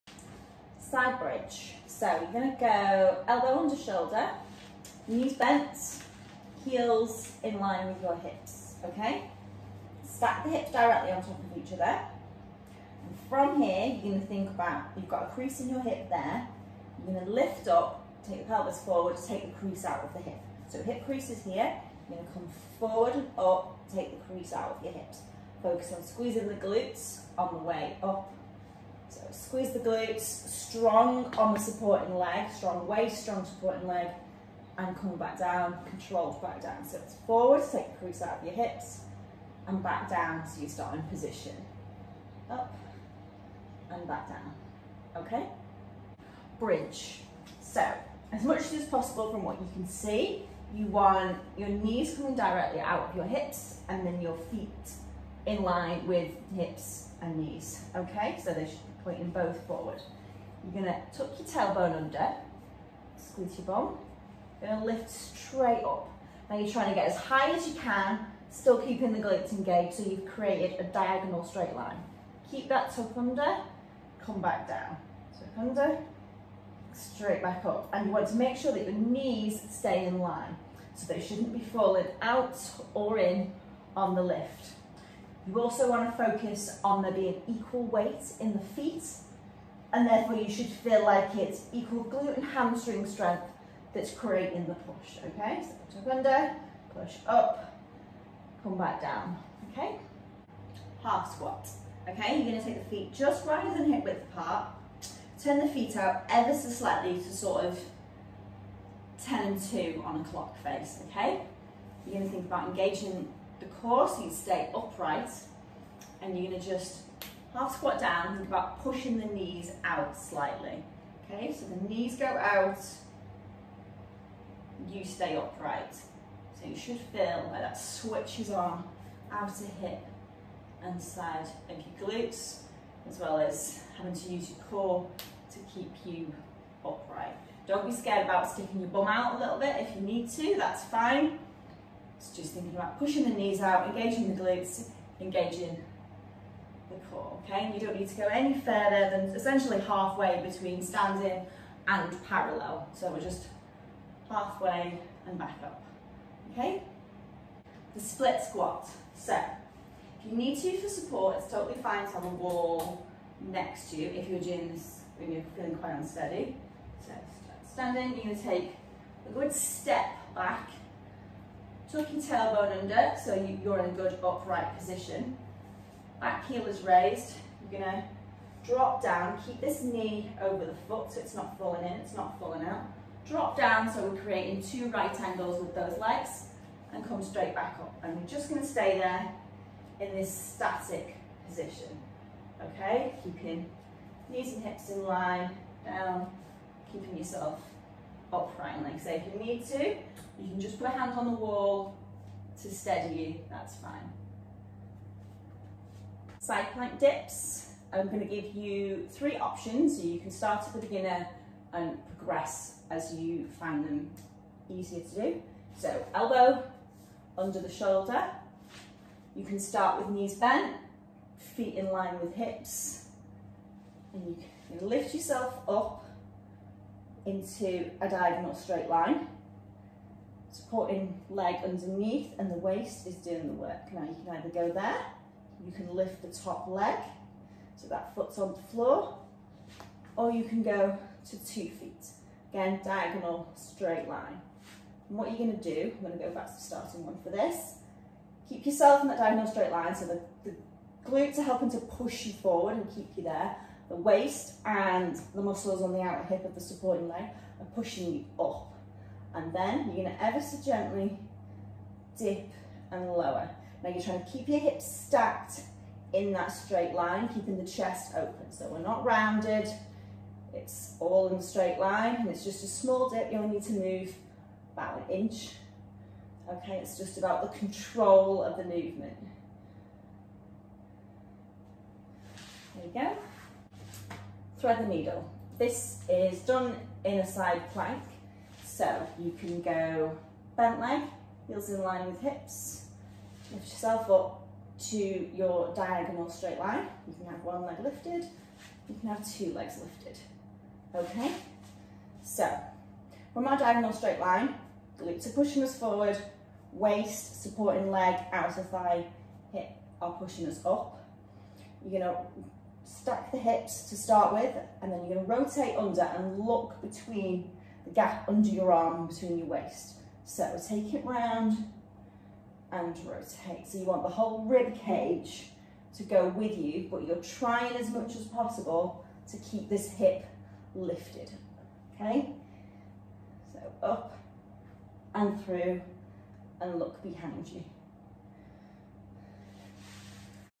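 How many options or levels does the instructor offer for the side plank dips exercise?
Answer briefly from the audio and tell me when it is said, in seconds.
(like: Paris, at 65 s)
3, at 209 s.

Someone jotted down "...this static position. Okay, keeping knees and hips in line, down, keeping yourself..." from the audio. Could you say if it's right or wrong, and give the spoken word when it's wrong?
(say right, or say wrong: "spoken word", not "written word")
right.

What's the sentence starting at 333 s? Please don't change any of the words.
So up and through and look behind you.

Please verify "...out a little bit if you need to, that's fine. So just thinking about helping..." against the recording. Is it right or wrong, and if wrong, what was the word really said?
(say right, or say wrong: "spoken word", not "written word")
wrong: "pushing", not "helping".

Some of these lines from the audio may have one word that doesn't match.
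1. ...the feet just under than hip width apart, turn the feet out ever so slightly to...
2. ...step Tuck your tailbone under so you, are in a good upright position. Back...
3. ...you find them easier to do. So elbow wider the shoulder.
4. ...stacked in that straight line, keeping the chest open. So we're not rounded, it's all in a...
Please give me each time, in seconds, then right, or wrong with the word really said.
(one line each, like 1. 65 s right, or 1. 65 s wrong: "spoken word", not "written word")
1. 102 s wrong: "wider", not "under"
2. 169 s right
3. 213 s wrong: "under", not "wider"
4. 264 s right.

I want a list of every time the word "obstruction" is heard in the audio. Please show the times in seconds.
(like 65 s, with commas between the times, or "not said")
not said.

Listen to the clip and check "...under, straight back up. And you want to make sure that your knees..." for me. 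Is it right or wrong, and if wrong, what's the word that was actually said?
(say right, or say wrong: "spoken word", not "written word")
right.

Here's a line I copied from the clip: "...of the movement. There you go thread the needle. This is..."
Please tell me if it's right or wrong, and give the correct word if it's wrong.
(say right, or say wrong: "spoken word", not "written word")
right.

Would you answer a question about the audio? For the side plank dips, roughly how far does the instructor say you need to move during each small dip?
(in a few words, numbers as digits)
about an inch.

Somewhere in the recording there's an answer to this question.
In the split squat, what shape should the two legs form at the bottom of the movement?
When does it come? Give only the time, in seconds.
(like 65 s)
184 s.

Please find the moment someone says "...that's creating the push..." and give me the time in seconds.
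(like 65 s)
93 s.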